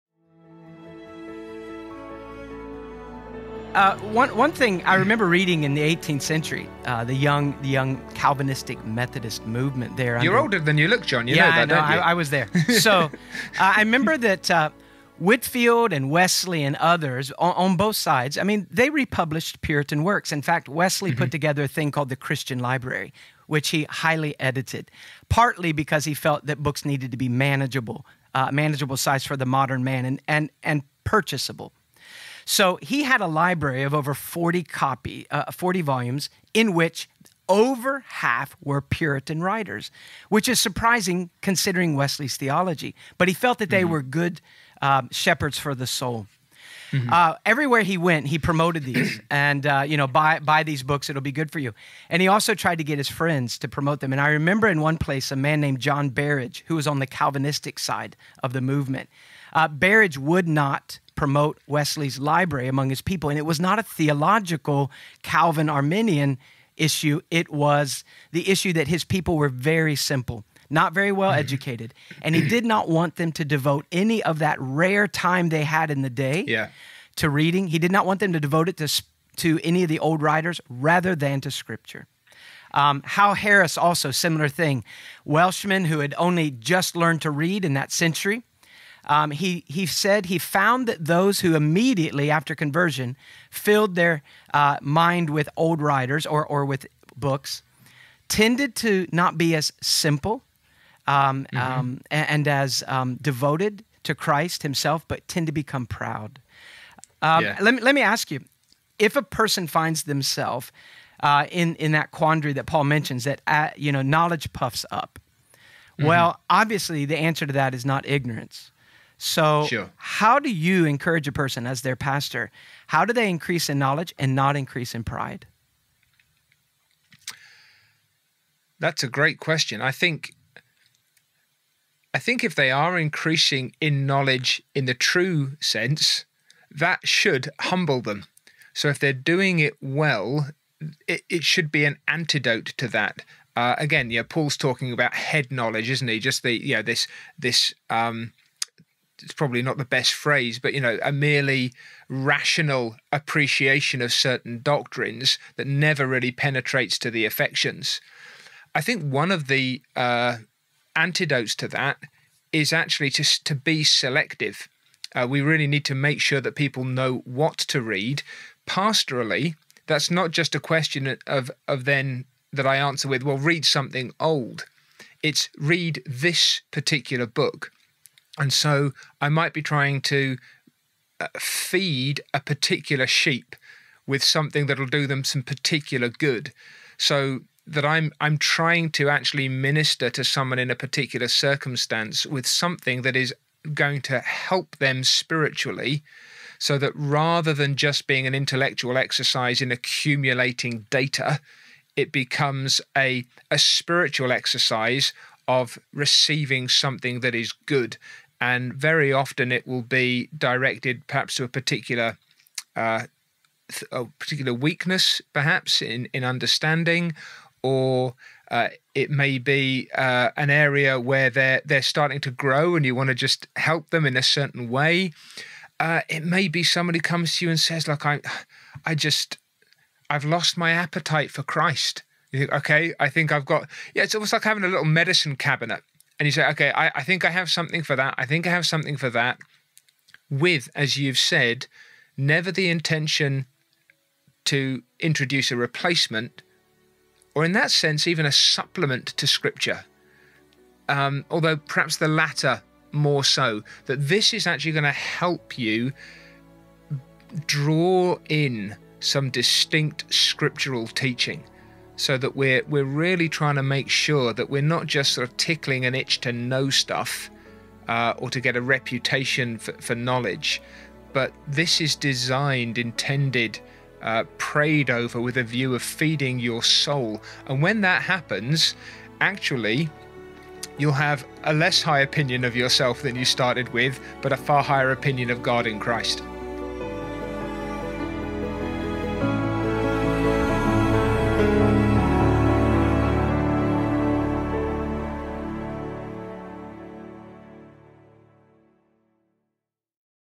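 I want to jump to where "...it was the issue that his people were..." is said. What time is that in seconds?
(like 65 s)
67 s.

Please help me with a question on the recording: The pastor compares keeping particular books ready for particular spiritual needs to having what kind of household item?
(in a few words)
a little medicine cabinet.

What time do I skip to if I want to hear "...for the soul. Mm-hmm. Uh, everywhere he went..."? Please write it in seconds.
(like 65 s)
45 s.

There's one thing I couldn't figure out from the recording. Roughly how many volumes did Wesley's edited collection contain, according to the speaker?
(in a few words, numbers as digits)
over 40.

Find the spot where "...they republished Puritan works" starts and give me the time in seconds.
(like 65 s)
18 s.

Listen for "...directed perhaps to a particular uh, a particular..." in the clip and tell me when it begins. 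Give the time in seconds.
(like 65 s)
210 s.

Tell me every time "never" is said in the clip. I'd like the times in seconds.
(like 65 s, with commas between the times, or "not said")
155 s, 242 s.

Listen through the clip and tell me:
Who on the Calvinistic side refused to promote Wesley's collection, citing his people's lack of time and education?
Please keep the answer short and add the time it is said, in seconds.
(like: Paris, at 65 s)
John Barrage, at 55 s.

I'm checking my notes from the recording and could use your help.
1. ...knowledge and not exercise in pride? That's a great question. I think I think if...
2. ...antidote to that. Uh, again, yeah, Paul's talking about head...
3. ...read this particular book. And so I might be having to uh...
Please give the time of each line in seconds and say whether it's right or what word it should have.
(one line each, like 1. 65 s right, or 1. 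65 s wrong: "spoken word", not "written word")
1. 123 s wrong: "increase", not "exercise"
2. 142 s right
3. 175 s wrong: "trying", not "having".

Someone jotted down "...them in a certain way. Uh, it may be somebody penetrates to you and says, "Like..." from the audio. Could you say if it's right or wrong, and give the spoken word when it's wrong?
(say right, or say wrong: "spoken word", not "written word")
wrong: "comes", not "penetrates".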